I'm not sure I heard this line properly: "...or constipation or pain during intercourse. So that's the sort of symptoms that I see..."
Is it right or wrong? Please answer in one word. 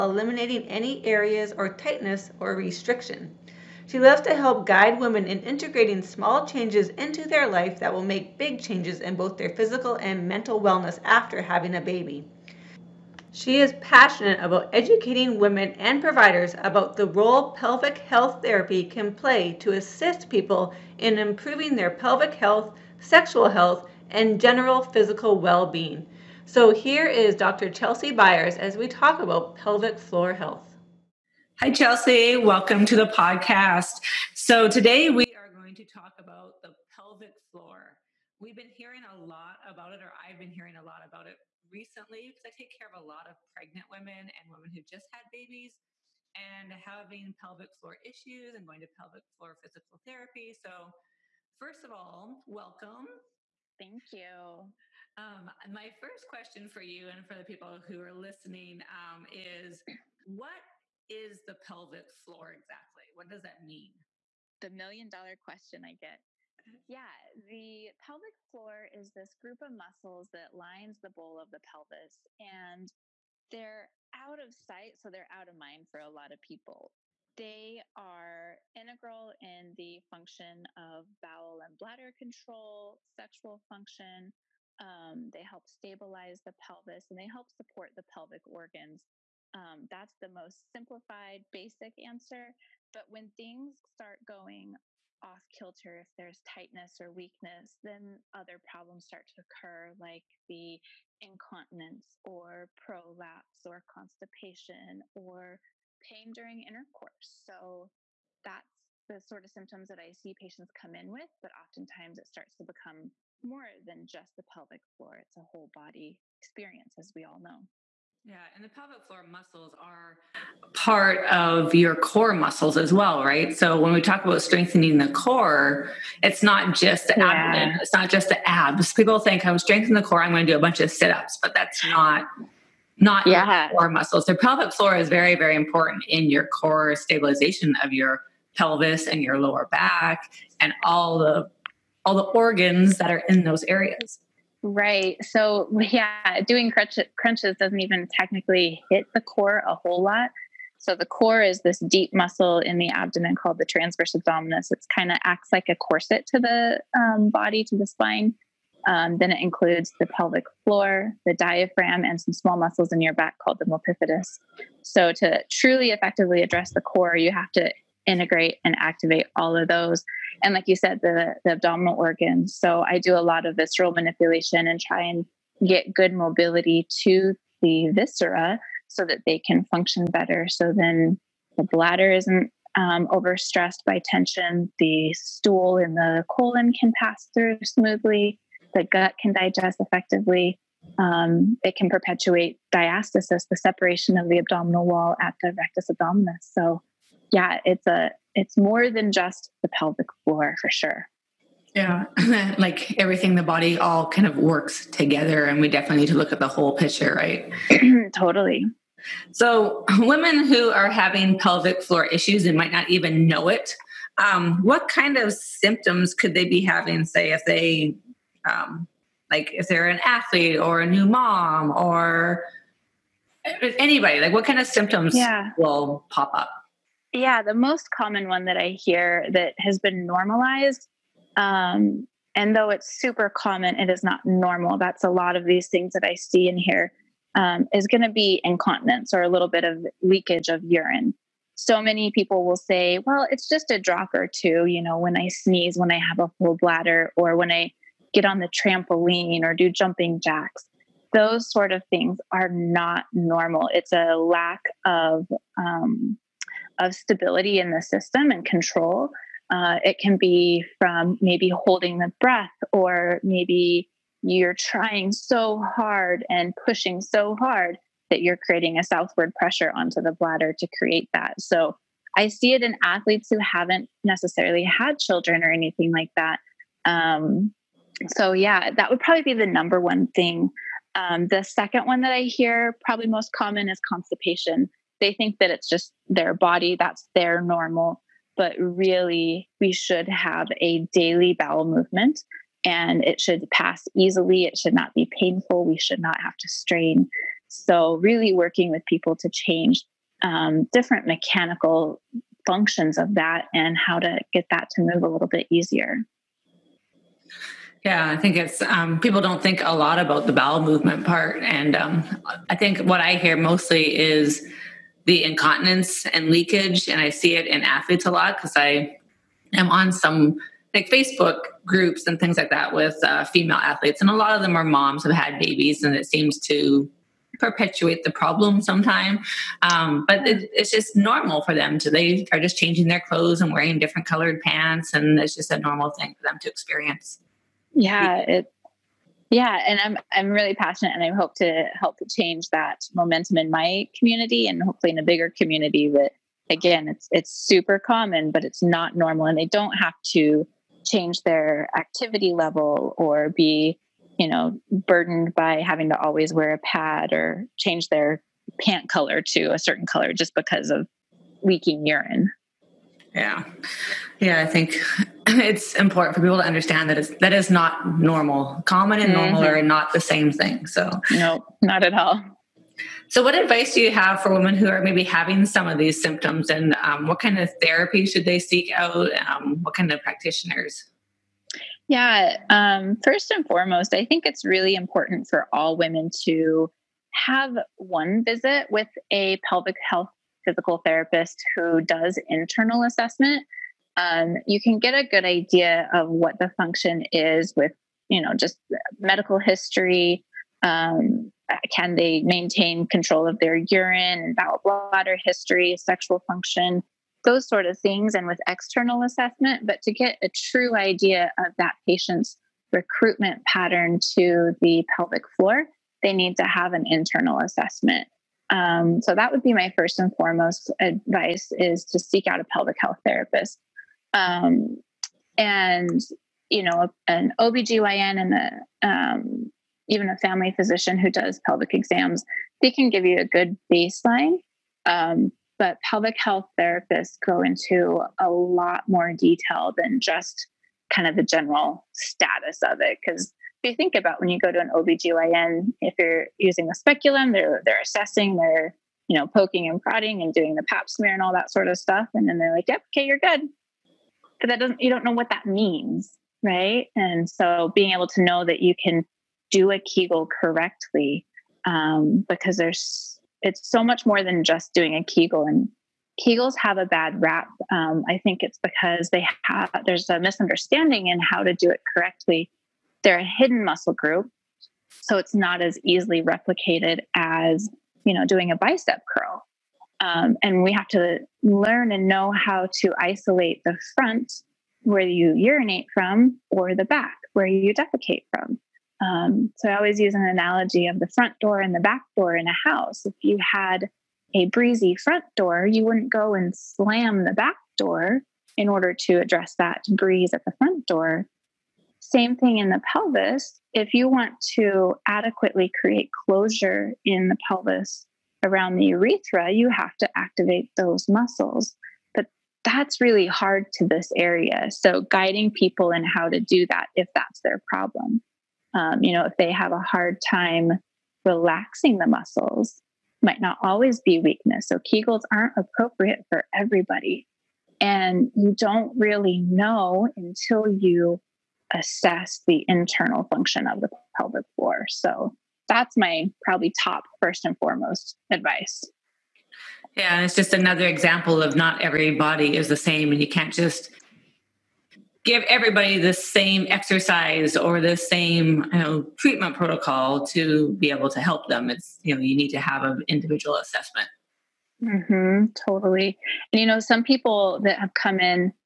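right.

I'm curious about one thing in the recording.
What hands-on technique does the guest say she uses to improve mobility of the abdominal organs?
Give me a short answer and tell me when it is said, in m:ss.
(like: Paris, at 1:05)
visceral manipulation, at 2:53.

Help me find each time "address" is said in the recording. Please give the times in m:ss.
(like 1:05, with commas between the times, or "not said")
2:46, 8:19.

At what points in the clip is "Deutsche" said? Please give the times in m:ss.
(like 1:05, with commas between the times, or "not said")
not said.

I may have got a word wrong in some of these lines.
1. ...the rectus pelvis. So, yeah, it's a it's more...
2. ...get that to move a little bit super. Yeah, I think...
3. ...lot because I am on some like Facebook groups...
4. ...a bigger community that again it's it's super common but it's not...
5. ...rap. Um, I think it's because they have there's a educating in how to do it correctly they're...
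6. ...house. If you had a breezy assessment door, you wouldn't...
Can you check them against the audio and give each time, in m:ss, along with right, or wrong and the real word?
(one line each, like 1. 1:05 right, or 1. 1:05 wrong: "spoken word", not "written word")
1. 3:15 wrong: "abdominis", not "pelvis"
2. 5:04 wrong: "easier", not "super"
3. 5:18 right
4. 5:44 right
5. 7:47 wrong: "misunderstanding", not "educating"
6. 8:12 wrong: "front", not "assessment".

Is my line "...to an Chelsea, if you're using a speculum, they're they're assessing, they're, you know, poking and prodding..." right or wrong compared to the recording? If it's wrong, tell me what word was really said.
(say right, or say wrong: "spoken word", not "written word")
wrong: "OBGYN", not "Chelsea".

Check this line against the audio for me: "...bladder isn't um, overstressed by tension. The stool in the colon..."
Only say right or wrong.
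right.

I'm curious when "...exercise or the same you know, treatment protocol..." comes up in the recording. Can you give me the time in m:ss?
9:06.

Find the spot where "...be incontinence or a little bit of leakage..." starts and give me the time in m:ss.
3:58.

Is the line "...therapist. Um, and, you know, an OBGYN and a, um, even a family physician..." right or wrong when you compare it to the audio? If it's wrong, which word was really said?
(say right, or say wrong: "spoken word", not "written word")
right.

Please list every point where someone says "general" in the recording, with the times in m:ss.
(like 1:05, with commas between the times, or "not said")
0:24, 7:21.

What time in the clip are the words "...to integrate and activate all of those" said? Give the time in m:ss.
2:47.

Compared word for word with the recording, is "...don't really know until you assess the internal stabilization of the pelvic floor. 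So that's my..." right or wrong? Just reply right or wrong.
wrong.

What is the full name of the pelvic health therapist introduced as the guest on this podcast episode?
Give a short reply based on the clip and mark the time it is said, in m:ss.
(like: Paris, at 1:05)
Chelsea Beyers, at 0:27.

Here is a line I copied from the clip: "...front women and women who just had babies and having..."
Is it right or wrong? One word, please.
wrong.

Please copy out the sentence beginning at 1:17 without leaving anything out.
They are integral in the function of bowel and bladder control, sexual function.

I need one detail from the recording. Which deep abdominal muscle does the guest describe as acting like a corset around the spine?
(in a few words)
transverse abdominis.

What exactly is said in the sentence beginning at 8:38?
Um, you know, if they have a hard time relaxing the muscles, might not always be weakness.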